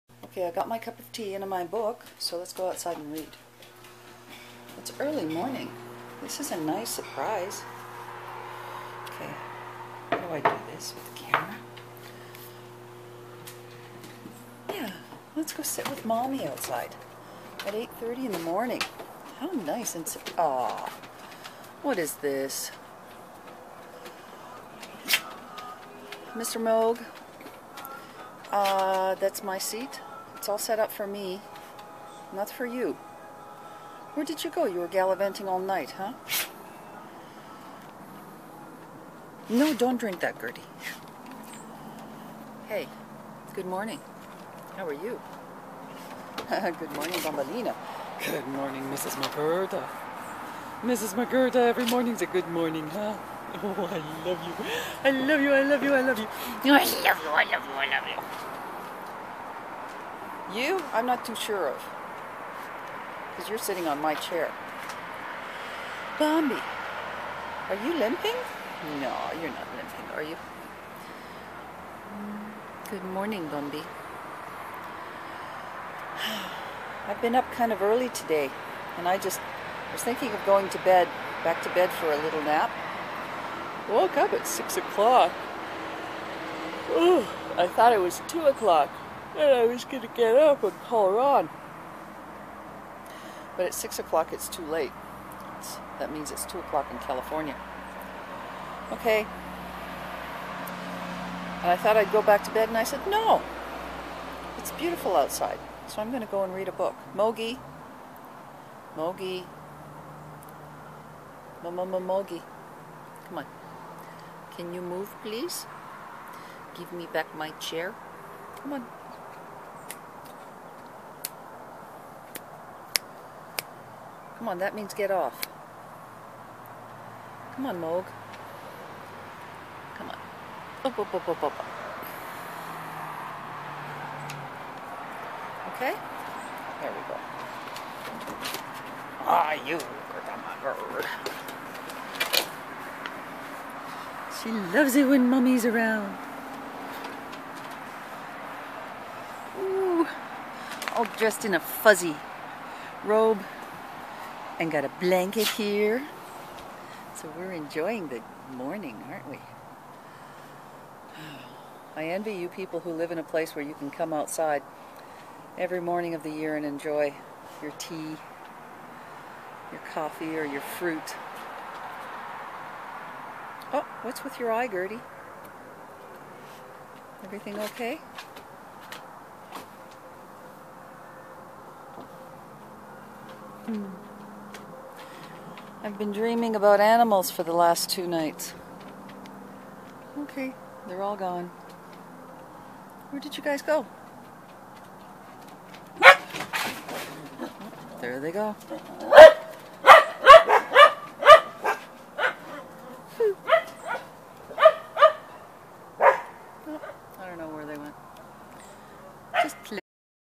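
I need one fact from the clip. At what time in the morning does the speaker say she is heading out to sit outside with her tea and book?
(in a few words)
8:30.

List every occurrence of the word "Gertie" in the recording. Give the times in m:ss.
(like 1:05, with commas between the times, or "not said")
0:40, 2:54.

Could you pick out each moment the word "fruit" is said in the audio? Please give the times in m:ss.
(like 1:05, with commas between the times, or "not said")
2:50.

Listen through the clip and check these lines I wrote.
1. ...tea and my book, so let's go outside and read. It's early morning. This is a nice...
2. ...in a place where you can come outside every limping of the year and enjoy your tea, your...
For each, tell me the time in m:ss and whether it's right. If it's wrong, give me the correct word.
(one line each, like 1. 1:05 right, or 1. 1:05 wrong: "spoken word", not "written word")
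1. 0:01 right
2. 2:43 wrong: "morning", not "limping".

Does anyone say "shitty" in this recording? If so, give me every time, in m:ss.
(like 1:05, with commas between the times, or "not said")
not said.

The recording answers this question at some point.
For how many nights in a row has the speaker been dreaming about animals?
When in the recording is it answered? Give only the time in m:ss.
3:07.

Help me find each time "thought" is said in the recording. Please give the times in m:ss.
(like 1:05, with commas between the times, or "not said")
1:27, 1:41.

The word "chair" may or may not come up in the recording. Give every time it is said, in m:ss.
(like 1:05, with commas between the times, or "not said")
1:04, 1:57.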